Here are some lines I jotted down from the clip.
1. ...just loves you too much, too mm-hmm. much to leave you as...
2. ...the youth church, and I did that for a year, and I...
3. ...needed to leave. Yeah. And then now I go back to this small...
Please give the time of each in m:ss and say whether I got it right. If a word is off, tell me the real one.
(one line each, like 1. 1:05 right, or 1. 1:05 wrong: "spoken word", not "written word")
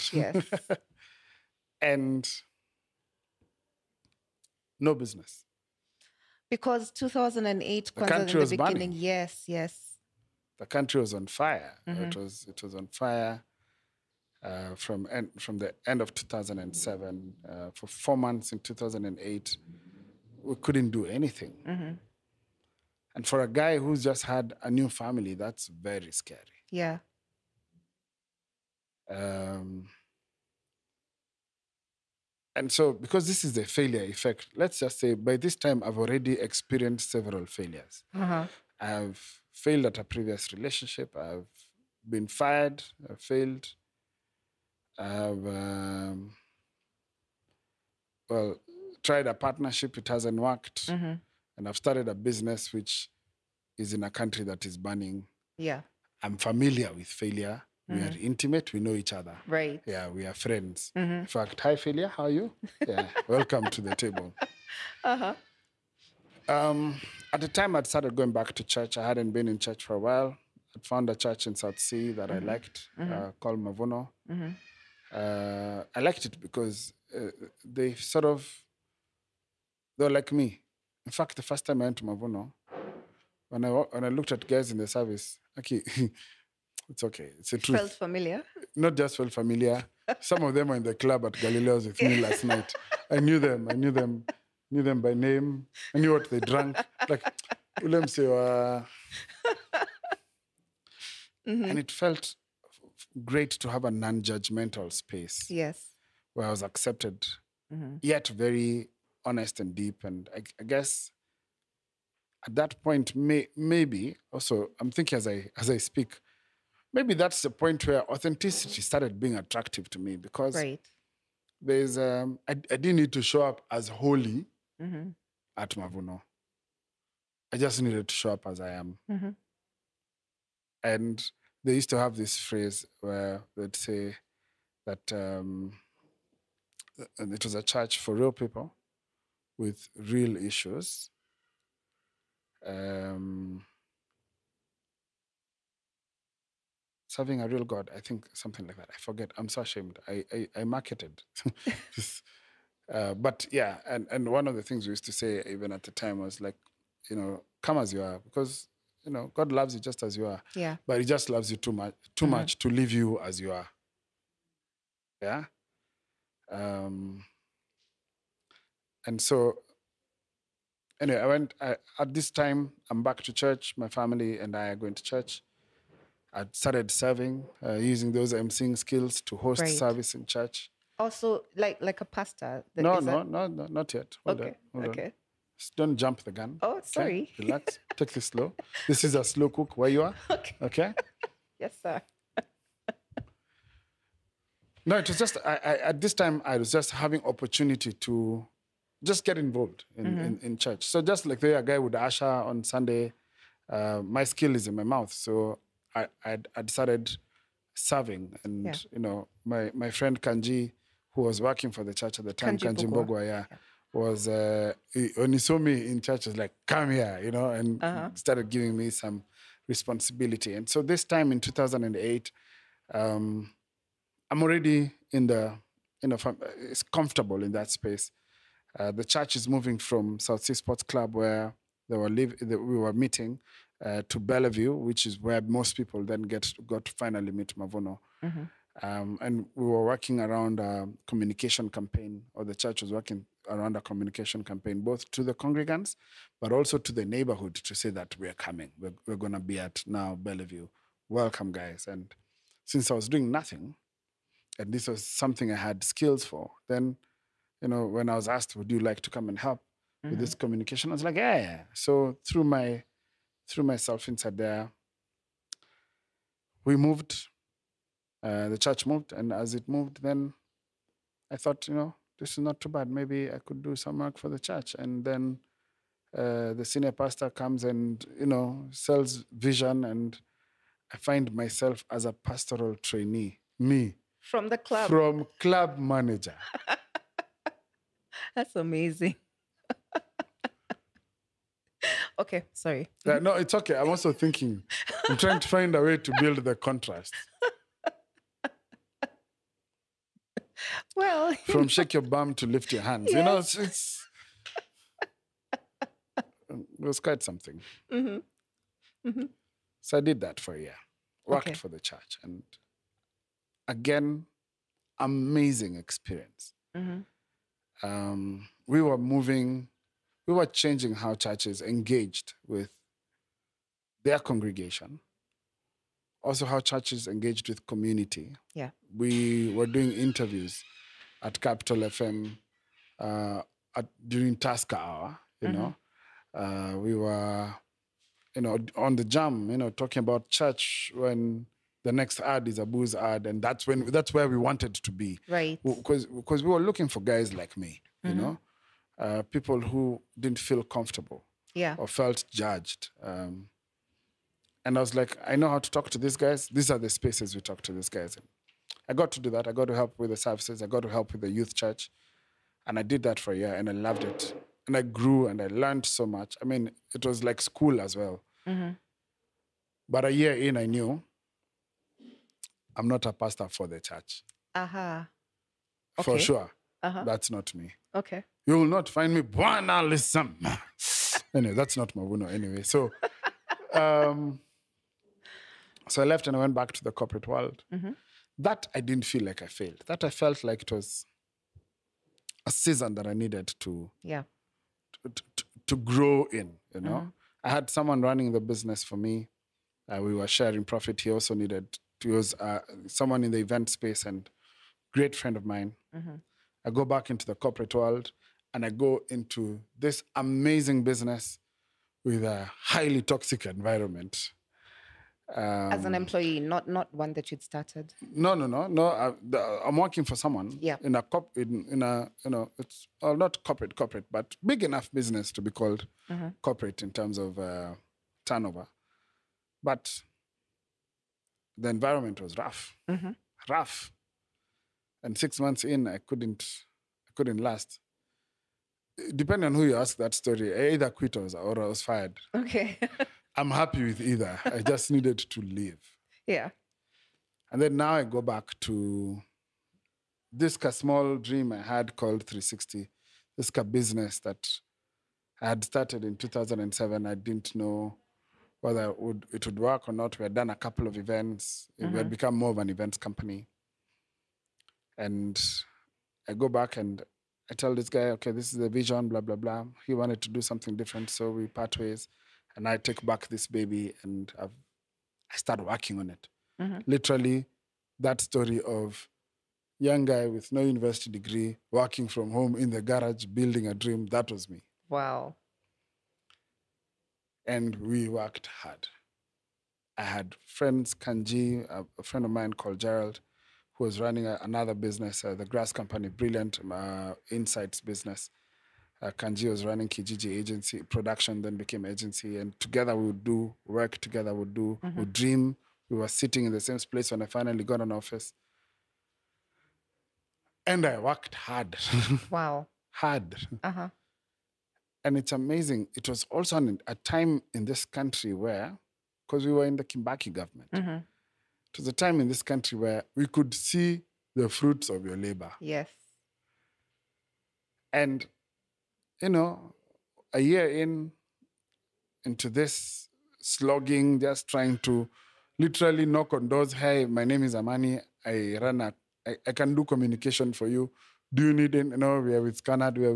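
1. 2:41 right
2. 6:01 right
3. 7:24 right.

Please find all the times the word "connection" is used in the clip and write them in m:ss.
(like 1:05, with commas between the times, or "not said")
not said.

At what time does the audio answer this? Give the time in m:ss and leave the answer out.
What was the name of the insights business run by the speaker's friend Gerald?
8:15.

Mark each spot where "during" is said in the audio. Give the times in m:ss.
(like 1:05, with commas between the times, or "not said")
5:34.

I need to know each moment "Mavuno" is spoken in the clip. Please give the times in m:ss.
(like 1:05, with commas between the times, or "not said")
1:13, 1:22, 2:05, 3:57, 6:21.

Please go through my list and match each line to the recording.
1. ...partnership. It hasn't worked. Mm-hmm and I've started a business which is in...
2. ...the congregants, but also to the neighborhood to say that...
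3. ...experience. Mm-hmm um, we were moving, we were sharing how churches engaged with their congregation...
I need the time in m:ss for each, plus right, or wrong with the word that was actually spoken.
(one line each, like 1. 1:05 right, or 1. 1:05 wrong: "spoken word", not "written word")
1. 0:49 right
2. 4:05 right
3. 5:15 wrong: "changing", not "sharing".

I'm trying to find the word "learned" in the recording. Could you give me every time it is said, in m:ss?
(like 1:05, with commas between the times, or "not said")
6:05.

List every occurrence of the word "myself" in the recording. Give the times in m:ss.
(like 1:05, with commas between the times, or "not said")
4:23, 4:41.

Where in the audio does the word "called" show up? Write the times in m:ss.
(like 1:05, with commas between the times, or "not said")
1:13, 7:05, 7:31, 8:12.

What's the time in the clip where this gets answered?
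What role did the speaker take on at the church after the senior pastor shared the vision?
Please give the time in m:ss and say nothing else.
4:42.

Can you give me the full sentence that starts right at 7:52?
And I take back this baby and I've, i start working on it.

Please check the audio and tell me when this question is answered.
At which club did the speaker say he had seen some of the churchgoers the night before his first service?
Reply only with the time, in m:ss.
1:31.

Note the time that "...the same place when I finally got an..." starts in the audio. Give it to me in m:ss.
8:26.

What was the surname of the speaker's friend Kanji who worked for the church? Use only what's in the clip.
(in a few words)
Bogwa.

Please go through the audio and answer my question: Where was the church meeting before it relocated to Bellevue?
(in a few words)
South C Sports Club.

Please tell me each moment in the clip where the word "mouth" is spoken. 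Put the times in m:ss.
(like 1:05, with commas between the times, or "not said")
3:24.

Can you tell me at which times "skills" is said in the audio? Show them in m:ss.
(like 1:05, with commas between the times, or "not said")
2:58, 3:24, 4:15.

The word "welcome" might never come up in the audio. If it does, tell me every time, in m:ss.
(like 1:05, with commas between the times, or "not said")
1:03, 4:11.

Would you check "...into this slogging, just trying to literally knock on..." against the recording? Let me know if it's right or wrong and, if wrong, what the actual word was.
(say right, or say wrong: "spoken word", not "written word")
right.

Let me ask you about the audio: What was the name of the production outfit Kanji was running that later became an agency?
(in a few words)
Kijiji Agency.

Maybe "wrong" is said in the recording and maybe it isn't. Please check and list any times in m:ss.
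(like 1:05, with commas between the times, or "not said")
not said.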